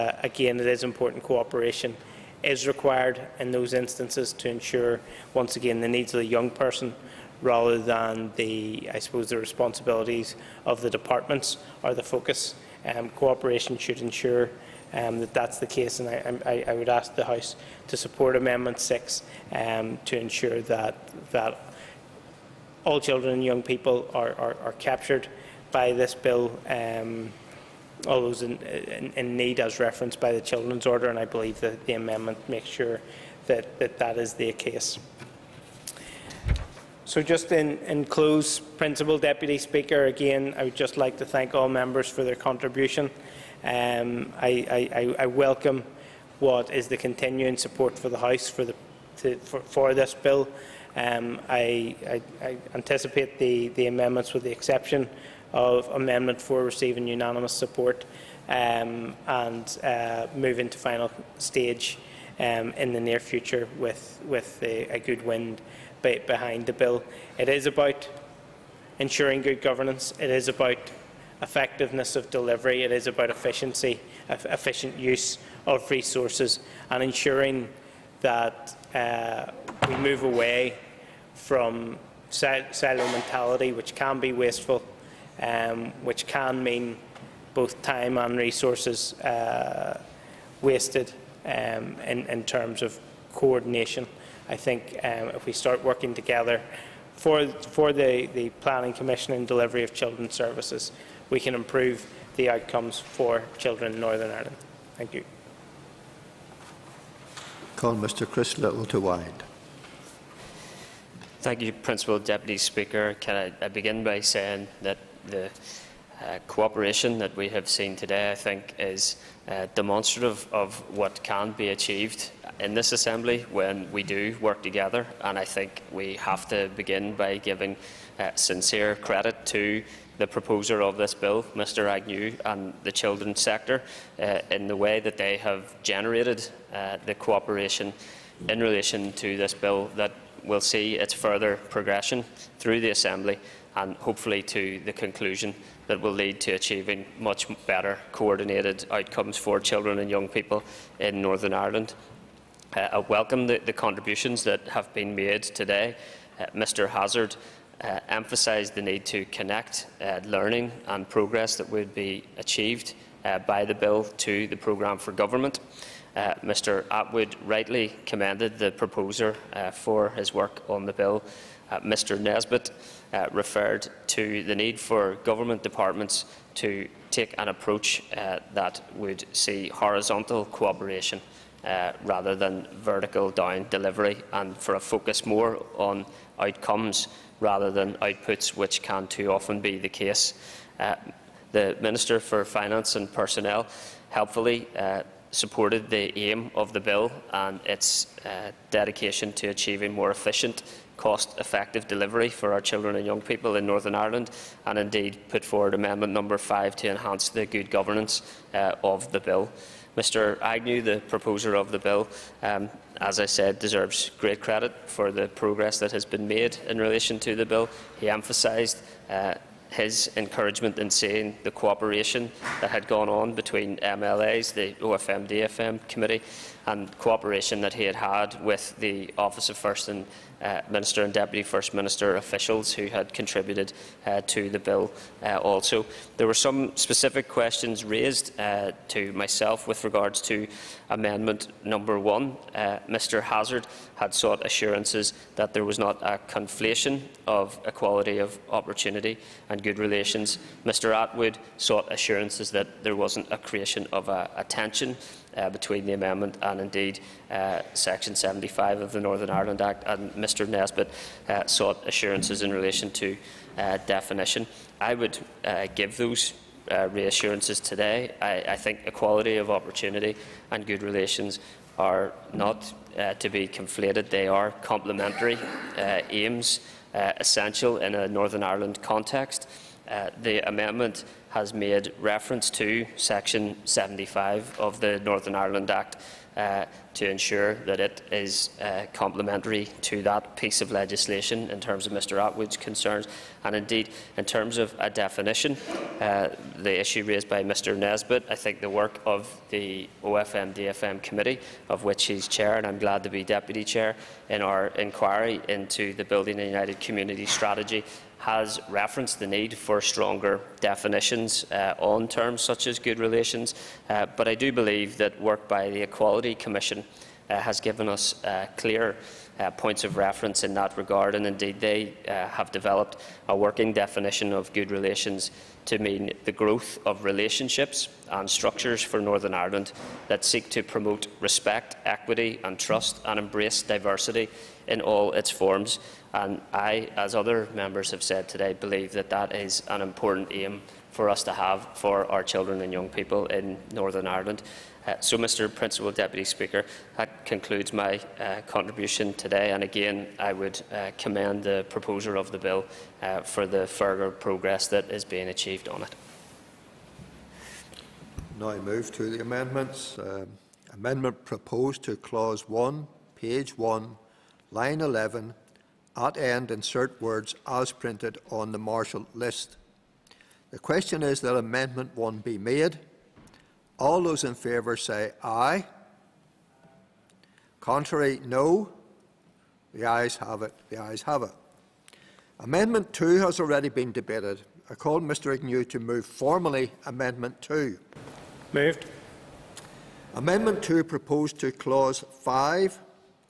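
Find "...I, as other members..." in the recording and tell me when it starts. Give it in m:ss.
5:36.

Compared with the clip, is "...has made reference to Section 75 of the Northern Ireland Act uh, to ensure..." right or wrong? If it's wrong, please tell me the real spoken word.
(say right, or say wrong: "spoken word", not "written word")
right.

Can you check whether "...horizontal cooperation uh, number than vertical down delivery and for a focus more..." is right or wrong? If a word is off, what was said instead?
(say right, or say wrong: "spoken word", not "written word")
wrong: "rather", not "number".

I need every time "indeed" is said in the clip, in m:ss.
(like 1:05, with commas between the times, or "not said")
3:24, 4:16, 4:53, 5:21.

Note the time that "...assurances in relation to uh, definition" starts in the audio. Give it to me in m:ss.
4:21.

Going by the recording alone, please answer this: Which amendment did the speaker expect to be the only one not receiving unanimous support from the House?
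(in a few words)
Amendment 4.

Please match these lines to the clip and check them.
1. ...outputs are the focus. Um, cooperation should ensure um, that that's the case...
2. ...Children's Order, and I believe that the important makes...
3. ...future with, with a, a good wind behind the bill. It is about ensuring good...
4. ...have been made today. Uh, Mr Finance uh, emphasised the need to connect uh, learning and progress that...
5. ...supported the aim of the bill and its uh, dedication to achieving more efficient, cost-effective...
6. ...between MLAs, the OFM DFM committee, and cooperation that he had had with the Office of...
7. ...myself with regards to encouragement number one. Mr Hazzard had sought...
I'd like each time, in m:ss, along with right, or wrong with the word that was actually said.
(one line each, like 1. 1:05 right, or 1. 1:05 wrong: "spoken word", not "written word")
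1. 0:10 wrong: "departments", not "outputs"
2. 0:30 wrong: "amendment", not "important"
3. 1:03 right
4. 2:34 wrong: "Hazzard", not "Finance"
5. 3:15 right
6. 3:43 right
7. 3:59 wrong: "amendment", not "encouragement".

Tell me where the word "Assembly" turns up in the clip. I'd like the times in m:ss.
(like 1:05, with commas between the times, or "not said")
2:02, 2:22.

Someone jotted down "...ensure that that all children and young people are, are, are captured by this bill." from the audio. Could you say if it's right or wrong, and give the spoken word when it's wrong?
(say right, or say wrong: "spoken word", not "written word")
right.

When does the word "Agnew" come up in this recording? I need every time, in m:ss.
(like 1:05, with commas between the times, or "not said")
2:11, 3:30, 6:25.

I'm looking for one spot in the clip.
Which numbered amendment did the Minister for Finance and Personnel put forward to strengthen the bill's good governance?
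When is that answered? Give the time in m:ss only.
3:25.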